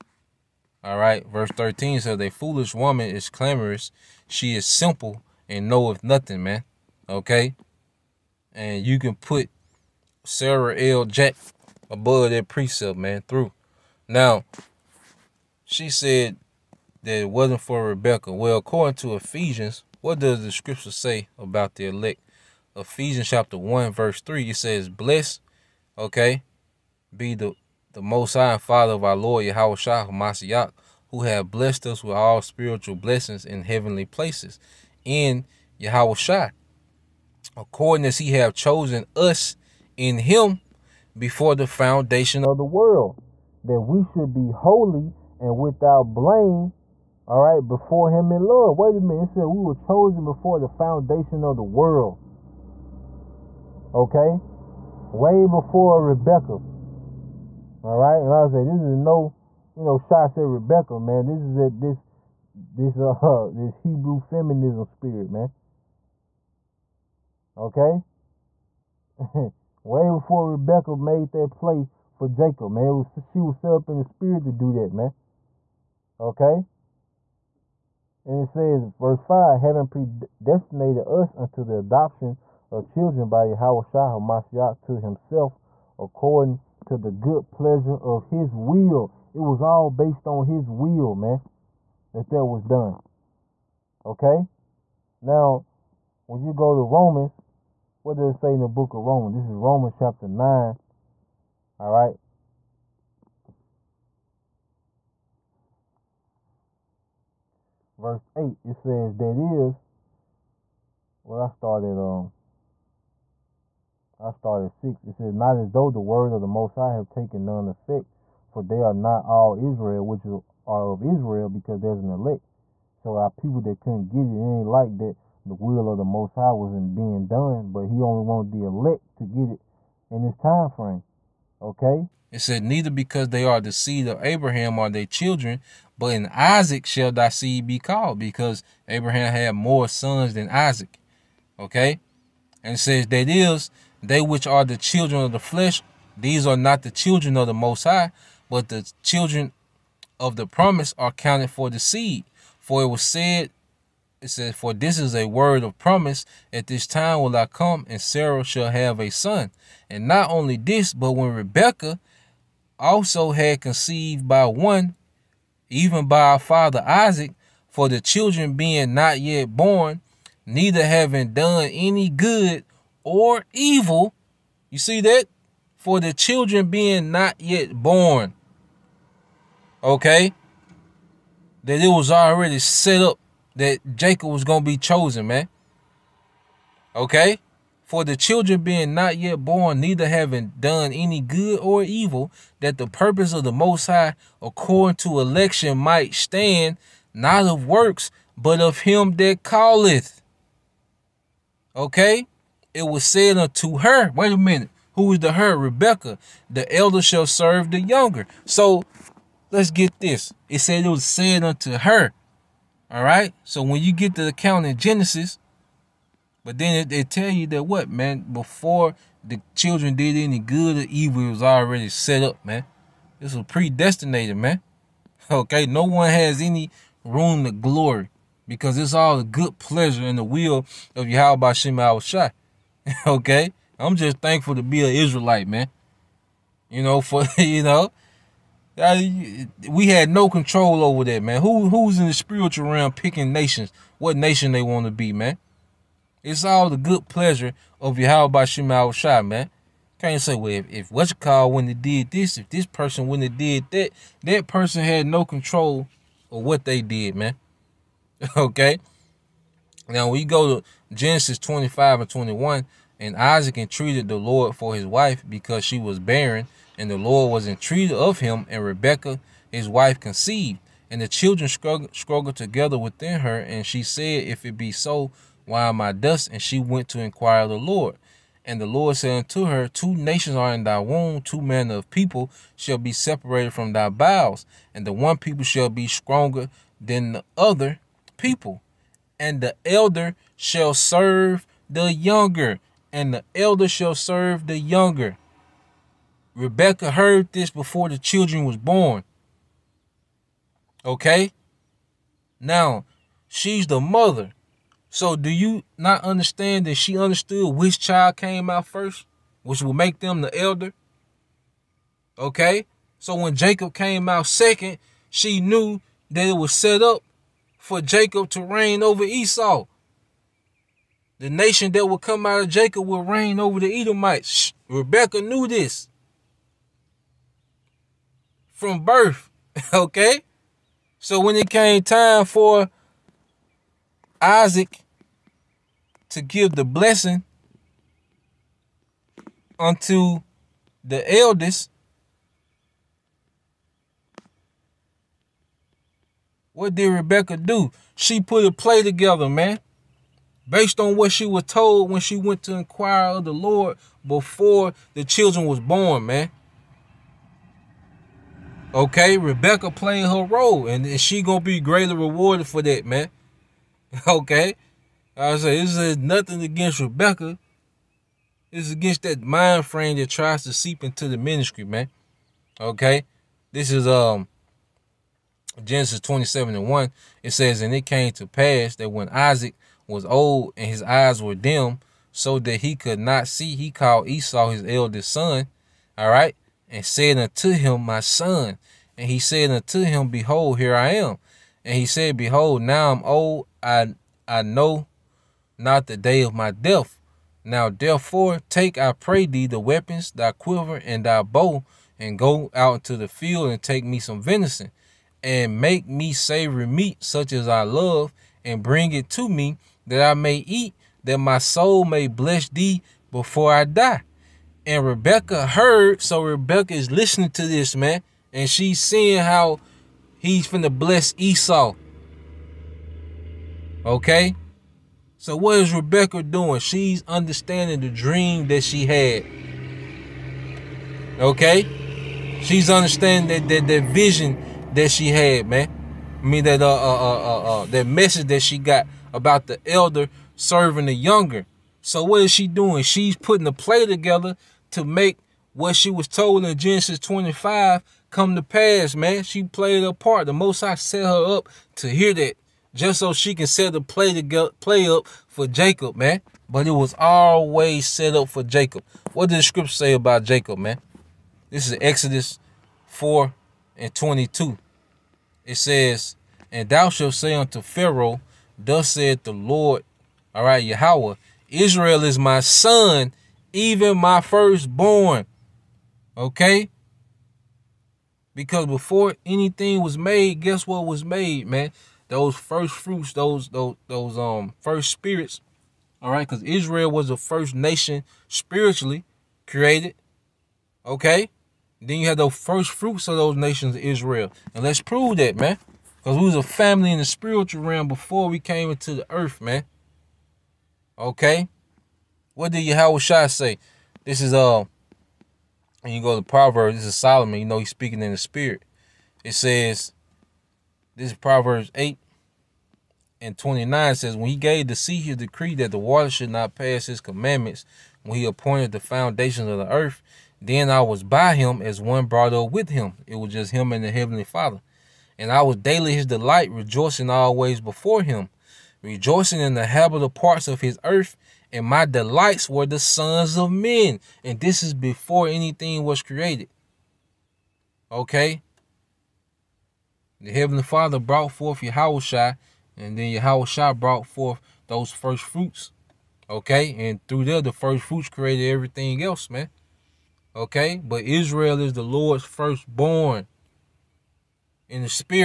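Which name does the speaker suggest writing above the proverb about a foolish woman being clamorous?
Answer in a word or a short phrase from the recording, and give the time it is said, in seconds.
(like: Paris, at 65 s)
Sarah L. Jack, at 10 s.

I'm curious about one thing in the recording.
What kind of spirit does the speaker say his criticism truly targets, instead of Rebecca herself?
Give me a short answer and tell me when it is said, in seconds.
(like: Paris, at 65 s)
Hebrew feminism spirit, at 63 s.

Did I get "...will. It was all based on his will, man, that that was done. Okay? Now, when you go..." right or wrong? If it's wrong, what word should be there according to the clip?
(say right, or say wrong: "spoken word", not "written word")
right.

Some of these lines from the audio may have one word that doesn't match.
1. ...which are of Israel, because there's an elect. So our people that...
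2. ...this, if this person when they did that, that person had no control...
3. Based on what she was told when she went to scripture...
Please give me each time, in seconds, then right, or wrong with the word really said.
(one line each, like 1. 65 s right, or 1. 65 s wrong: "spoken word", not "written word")
1. 120 s right
2. 252 s right
3. 350 s wrong: "inquire", not "scripture".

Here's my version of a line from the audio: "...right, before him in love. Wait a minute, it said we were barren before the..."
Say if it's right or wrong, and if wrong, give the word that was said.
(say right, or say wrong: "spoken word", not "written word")
wrong: "chosen", not "barren".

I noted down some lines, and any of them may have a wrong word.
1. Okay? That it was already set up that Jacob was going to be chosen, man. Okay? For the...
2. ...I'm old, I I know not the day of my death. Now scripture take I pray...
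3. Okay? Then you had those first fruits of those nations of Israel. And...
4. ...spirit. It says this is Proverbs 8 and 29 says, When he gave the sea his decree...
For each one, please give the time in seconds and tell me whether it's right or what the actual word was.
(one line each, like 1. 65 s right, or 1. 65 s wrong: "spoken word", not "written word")
1. 179 s right
2. 392 s wrong: "therefore", not "scripture"
3. 490 s right
4. 508 s right.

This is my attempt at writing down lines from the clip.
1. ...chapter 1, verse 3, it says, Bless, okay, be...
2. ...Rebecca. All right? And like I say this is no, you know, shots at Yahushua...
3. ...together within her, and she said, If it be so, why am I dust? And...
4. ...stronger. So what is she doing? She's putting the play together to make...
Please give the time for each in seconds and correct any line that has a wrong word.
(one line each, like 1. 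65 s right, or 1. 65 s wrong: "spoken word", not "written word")
1. 23 s right
2. 56 s wrong: "Rebecca", not "Yahushua"
3. 272 s right
4. 440 s wrong: "younger", not "stronger".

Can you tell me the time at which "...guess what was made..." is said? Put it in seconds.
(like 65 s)
480 s.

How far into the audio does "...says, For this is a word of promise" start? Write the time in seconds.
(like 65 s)
154 s.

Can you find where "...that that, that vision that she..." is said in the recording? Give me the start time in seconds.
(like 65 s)
433 s.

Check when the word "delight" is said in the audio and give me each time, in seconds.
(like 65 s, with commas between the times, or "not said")
526 s, 531 s.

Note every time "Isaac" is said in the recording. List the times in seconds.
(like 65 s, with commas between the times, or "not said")
136 s, 140 s, 166 s, 263 s, 334 s, 379 s.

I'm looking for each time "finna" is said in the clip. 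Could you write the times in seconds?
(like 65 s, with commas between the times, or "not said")
420 s.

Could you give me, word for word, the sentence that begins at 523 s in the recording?
It was just him and the heavenly father.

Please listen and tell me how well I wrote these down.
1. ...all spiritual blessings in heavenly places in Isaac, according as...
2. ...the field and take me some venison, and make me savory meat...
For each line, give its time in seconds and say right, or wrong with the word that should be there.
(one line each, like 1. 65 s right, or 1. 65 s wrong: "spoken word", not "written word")
1. 32 s wrong: "Yahawashi", not "Isaac"
2. 402 s right.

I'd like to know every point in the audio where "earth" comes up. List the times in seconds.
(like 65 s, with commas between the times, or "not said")
499 s, 519 s, 530 s.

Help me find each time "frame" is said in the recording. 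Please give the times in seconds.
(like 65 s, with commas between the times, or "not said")
130 s, 369 s.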